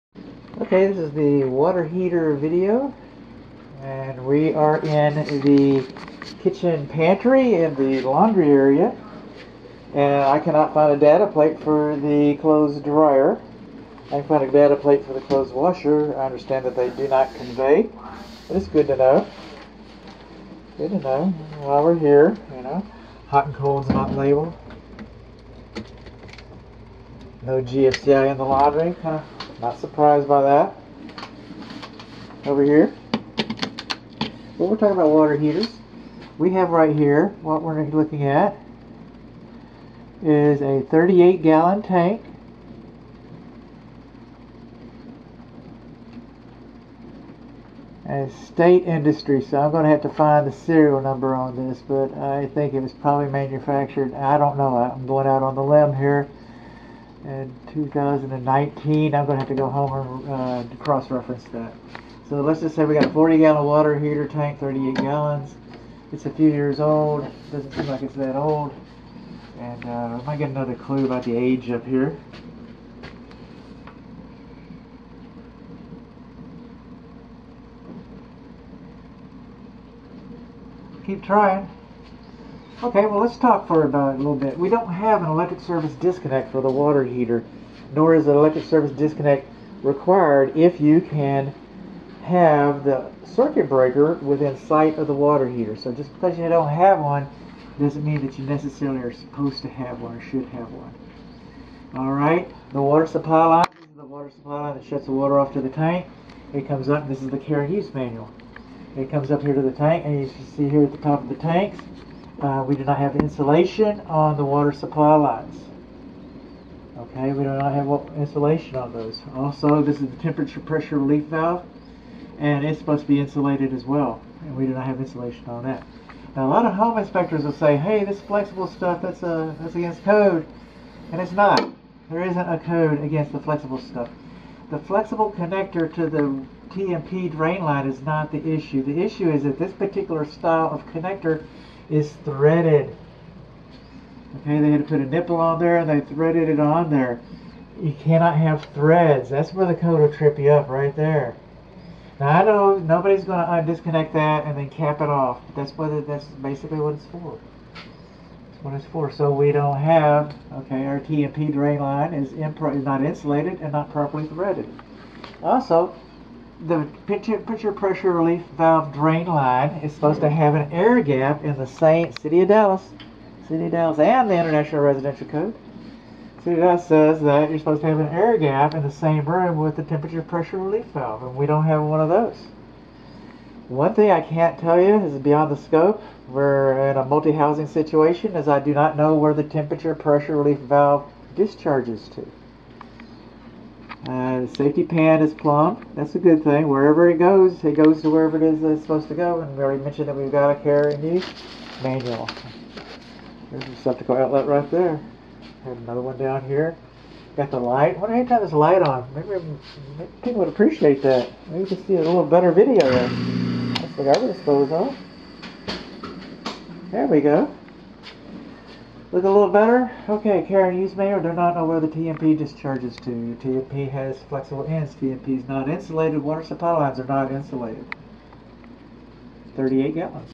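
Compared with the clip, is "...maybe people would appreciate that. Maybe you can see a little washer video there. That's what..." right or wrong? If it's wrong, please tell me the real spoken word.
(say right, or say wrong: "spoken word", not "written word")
wrong: "better", not "washer".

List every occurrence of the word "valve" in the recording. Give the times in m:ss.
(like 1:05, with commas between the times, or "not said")
2:01, 2:48, 3:00, 3:10.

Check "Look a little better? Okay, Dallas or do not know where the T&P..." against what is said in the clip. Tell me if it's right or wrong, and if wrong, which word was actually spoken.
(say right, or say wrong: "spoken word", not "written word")
wrong: "Karen", not "Dallas".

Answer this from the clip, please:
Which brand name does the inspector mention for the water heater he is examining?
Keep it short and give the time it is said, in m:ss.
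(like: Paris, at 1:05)
State Industry, at 0:48.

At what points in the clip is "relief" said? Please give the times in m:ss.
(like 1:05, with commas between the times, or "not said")
2:00, 2:48, 3:00, 3:10.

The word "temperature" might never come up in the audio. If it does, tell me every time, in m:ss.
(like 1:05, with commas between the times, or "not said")
2:00, 2:59, 3:09.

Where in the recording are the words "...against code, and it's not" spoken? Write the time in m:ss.
2:09.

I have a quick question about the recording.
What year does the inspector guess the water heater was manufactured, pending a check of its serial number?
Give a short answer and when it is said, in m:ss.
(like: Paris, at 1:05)
2019, at 0:57.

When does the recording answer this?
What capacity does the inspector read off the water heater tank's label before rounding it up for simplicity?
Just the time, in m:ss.
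0:40.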